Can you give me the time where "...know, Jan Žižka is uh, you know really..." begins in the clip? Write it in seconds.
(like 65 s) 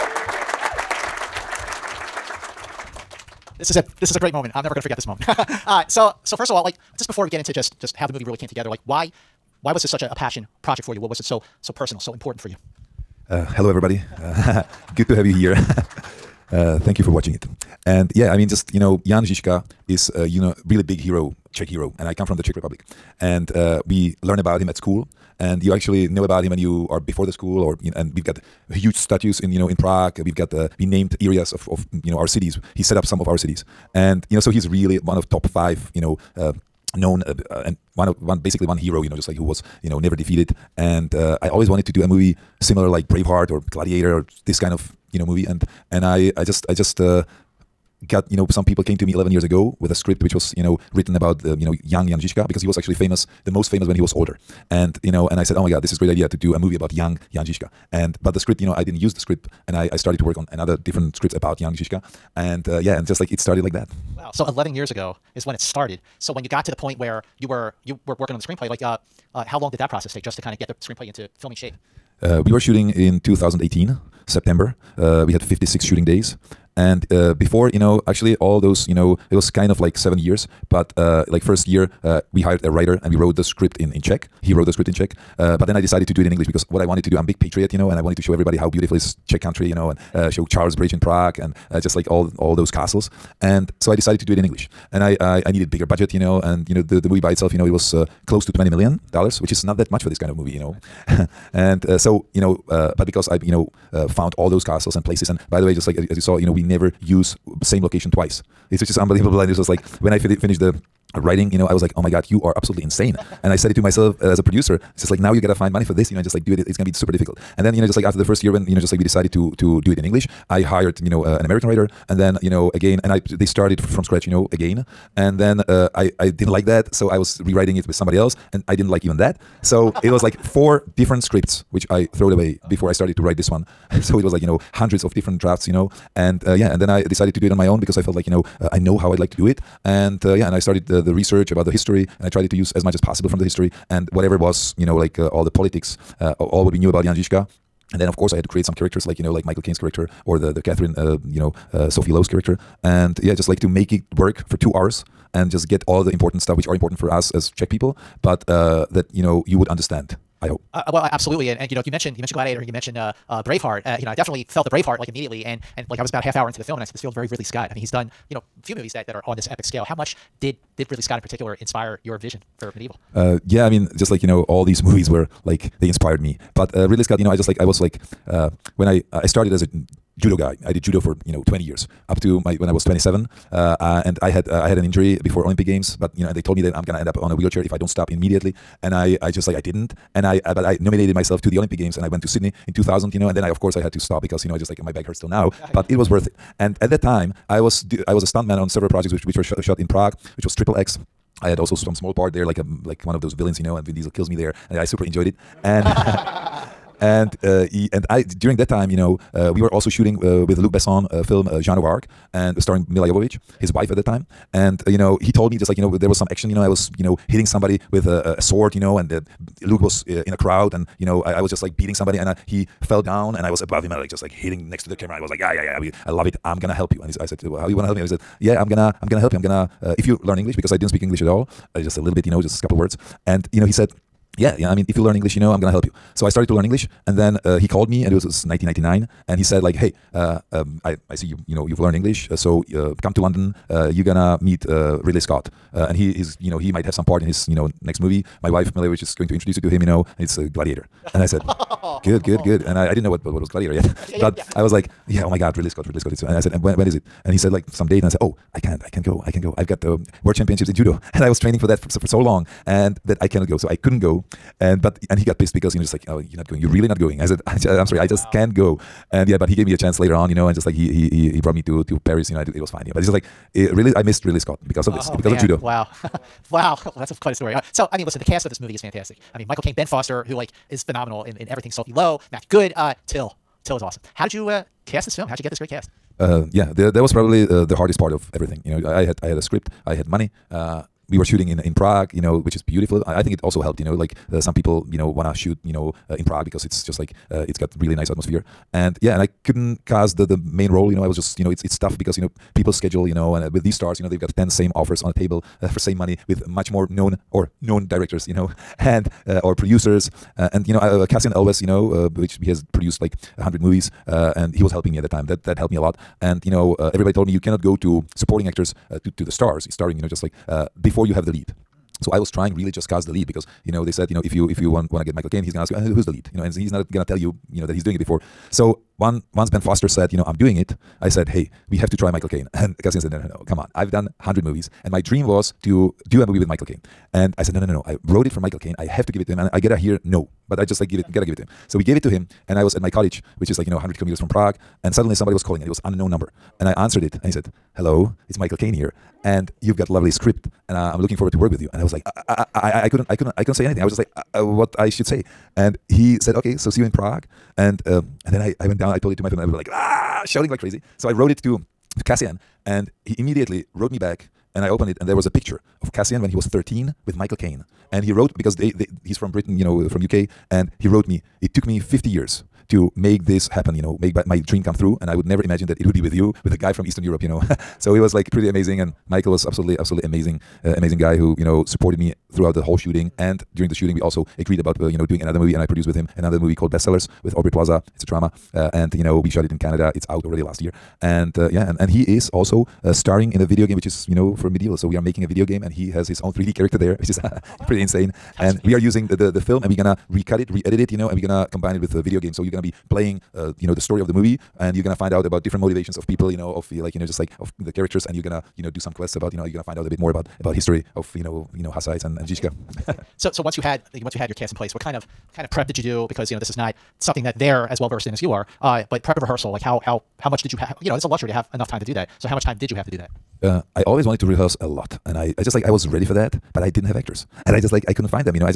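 18 s.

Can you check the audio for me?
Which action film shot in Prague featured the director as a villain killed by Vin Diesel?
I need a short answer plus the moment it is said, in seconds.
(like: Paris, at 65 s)
Triple X, at 200 s.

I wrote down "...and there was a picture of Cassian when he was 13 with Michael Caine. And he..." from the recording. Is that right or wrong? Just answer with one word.
right.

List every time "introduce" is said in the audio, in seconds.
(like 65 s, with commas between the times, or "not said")
249 s.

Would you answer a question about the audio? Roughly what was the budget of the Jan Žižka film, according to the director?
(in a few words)
close to 20 million dollars.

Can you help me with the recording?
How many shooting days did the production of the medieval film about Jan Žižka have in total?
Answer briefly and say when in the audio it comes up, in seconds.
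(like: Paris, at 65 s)
56, at 75 s.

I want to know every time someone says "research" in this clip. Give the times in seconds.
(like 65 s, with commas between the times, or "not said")
141 s.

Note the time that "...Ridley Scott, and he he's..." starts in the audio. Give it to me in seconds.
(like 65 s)
245 s.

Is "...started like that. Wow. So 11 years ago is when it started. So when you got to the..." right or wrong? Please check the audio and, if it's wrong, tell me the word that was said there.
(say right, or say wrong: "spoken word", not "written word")
right.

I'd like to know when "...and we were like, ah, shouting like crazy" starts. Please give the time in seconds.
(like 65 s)
359 s.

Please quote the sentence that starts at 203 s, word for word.
And Vin Diesel kills me there, and I super enjoyed it.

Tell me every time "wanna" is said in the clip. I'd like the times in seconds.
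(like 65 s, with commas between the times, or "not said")
227 s, 295 s.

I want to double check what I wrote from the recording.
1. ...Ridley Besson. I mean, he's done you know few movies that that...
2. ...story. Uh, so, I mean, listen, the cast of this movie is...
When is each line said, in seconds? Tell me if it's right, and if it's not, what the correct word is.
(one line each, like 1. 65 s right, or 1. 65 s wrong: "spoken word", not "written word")
1. 167 s wrong: "Scott", not "Besson"
2. 277 s right.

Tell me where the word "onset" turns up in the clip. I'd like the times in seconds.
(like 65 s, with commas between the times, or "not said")
not said.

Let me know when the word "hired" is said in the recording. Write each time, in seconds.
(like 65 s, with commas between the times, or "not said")
82 s, 120 s.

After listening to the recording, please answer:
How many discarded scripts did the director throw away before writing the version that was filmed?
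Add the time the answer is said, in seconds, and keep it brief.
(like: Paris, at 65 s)
4, at 130 s.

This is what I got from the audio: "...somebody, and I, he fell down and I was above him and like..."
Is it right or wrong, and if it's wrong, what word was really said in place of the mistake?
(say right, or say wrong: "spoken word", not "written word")
right.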